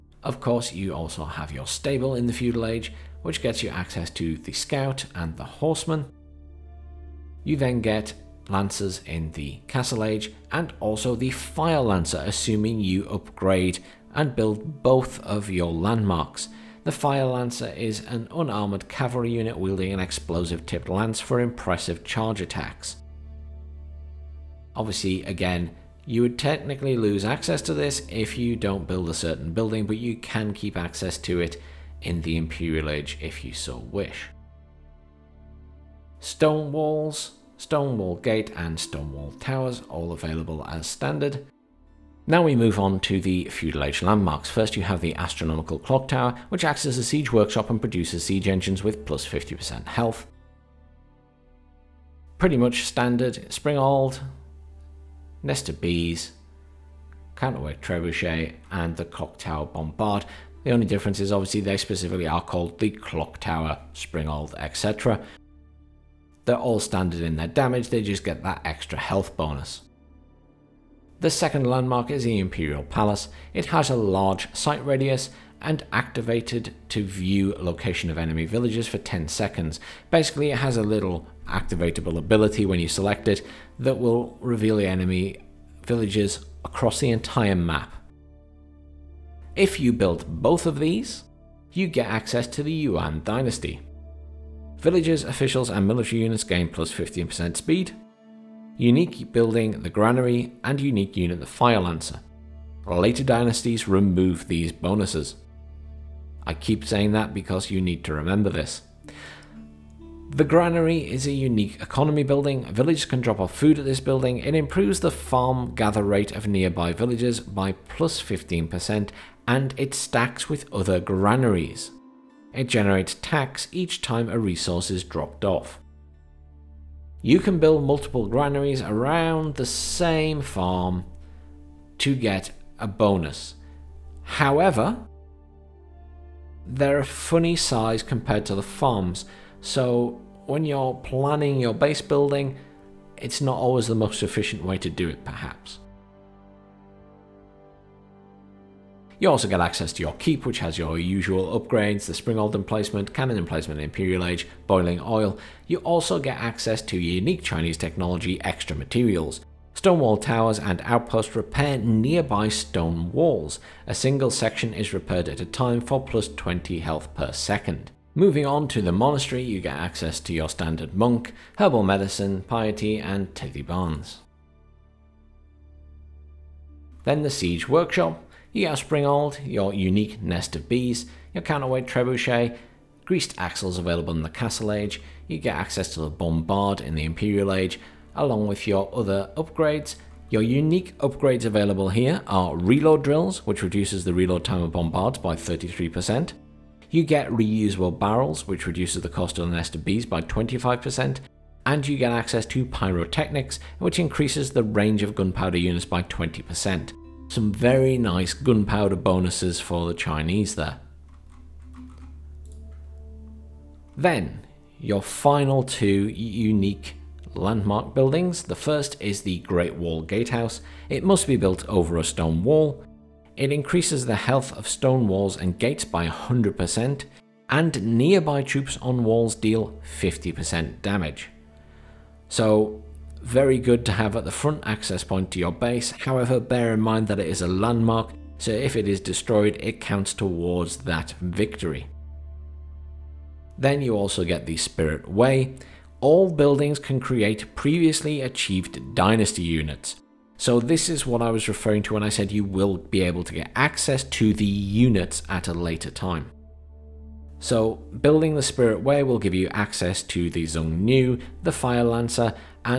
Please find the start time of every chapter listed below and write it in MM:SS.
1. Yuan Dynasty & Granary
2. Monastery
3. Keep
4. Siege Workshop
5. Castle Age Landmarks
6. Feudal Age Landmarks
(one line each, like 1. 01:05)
1. 01:28
2. 02:47
3. 02:27
4. 02:57
5. 03:32
6. 00:41.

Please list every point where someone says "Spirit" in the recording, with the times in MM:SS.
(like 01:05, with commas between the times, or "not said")
04:04, 04:18.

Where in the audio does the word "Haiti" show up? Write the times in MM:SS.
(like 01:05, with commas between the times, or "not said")
not said.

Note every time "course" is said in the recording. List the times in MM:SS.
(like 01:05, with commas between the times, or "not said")
00:00.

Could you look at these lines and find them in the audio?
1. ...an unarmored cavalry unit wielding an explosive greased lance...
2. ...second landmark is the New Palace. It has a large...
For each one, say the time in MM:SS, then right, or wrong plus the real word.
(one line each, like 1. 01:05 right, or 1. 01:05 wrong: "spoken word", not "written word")
1. 00:18 wrong: "tipped", not "greased"
2. 01:11 wrong: "Imperial", not "New".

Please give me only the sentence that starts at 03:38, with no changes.
The first is the Great Wall Gatehouse.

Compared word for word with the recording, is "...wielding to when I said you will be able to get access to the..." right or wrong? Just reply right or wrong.
wrong.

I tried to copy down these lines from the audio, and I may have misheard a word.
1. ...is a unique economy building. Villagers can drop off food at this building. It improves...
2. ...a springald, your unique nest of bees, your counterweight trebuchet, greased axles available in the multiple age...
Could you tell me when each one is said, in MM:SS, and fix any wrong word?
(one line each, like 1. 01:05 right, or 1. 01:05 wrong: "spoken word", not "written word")
1. 01:51 right
2. 02:58 wrong: "castle", not "multiple".